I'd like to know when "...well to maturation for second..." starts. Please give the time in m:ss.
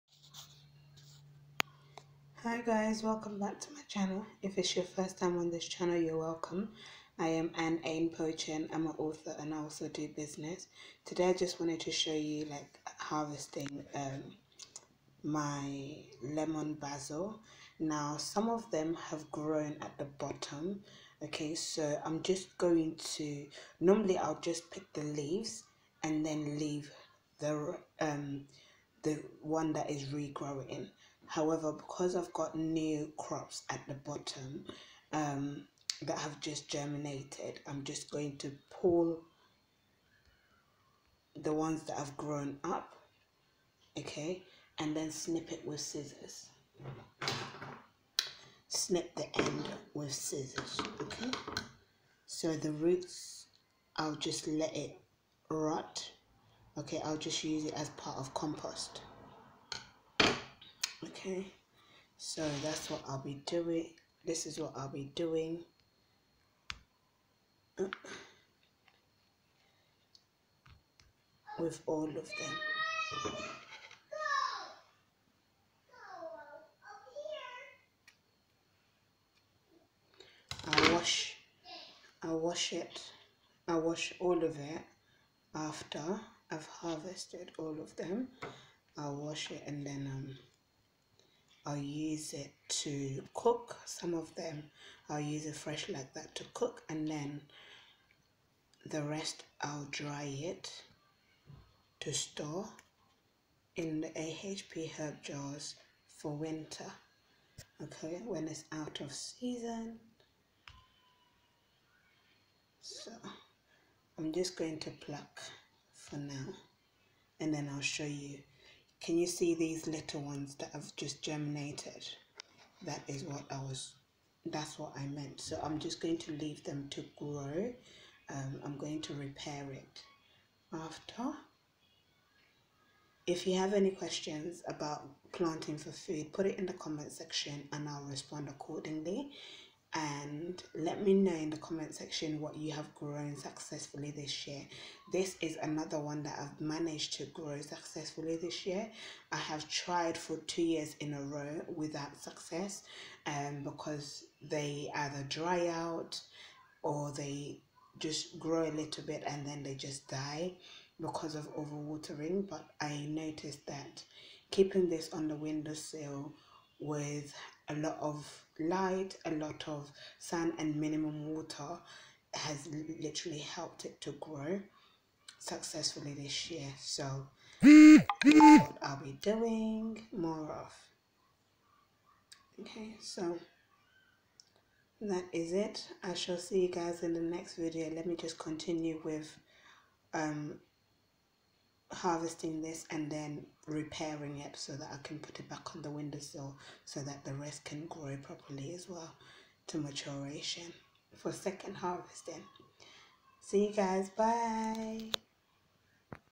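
3:18.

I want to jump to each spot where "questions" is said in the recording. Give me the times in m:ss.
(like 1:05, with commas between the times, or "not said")
2:13.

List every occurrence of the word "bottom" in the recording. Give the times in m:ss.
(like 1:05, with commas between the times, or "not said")
0:20, 0:33.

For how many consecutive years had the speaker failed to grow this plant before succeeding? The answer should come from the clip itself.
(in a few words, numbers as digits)
2.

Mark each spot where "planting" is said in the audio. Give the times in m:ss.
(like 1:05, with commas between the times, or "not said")
2:15.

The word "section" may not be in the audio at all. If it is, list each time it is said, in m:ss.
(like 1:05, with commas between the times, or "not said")
2:17, 2:21.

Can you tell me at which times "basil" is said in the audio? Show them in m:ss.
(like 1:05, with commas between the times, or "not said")
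0:16.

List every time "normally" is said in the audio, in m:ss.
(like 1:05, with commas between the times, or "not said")
0:23.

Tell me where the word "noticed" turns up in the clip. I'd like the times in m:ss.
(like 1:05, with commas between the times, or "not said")
2:43.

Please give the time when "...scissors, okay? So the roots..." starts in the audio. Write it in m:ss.
0:50.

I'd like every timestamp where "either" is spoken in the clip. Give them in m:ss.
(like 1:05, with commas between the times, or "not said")
2:34.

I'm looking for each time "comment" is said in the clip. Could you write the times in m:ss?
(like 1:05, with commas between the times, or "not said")
2:16, 2:21.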